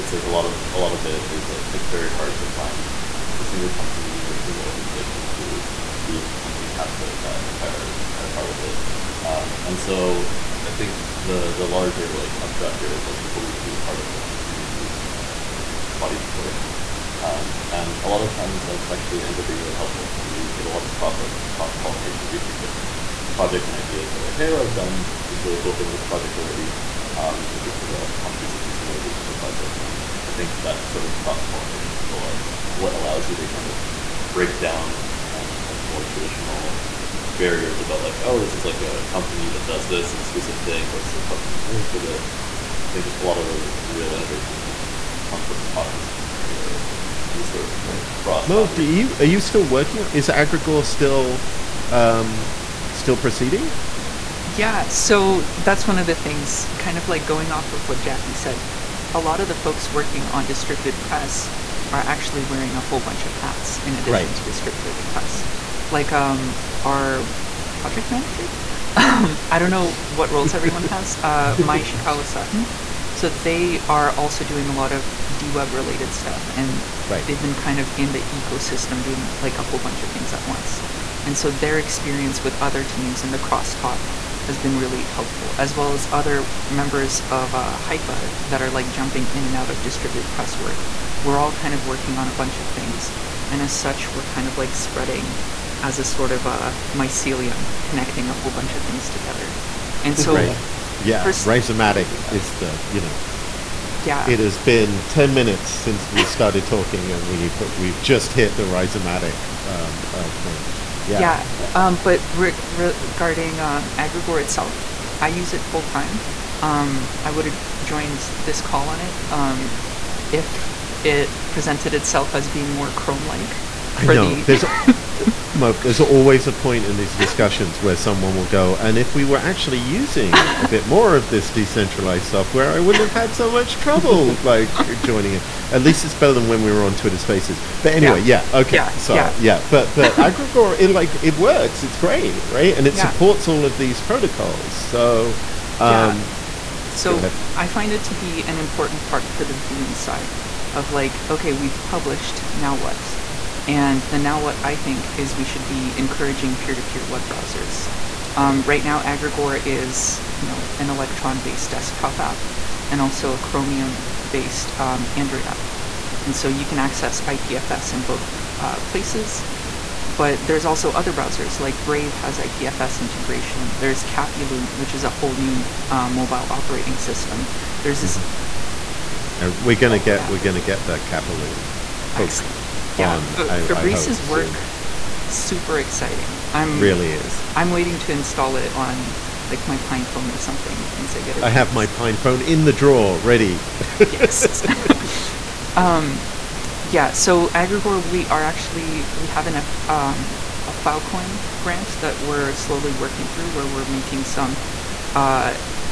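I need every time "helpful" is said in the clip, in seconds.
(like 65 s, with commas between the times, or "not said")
19 s, 85 s.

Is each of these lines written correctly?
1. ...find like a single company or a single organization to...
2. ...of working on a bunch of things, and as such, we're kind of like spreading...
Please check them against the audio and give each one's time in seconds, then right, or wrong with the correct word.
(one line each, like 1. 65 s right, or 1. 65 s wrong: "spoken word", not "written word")
1. 2 s right
2. 91 s right.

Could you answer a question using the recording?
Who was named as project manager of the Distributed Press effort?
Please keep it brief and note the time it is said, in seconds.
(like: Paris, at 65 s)
Mai Ishikawa Sutton, at 71 s.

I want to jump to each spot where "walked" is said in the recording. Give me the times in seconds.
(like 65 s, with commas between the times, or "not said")
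not said.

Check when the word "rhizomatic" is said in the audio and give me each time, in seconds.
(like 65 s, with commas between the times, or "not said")
101 s, 108 s.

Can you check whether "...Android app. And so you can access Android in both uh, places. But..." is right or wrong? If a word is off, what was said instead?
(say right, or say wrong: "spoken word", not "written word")
wrong: "IPFS", not "Android".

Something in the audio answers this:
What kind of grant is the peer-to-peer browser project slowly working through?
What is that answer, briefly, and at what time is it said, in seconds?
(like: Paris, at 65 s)
Filecoin grant, at 200 s.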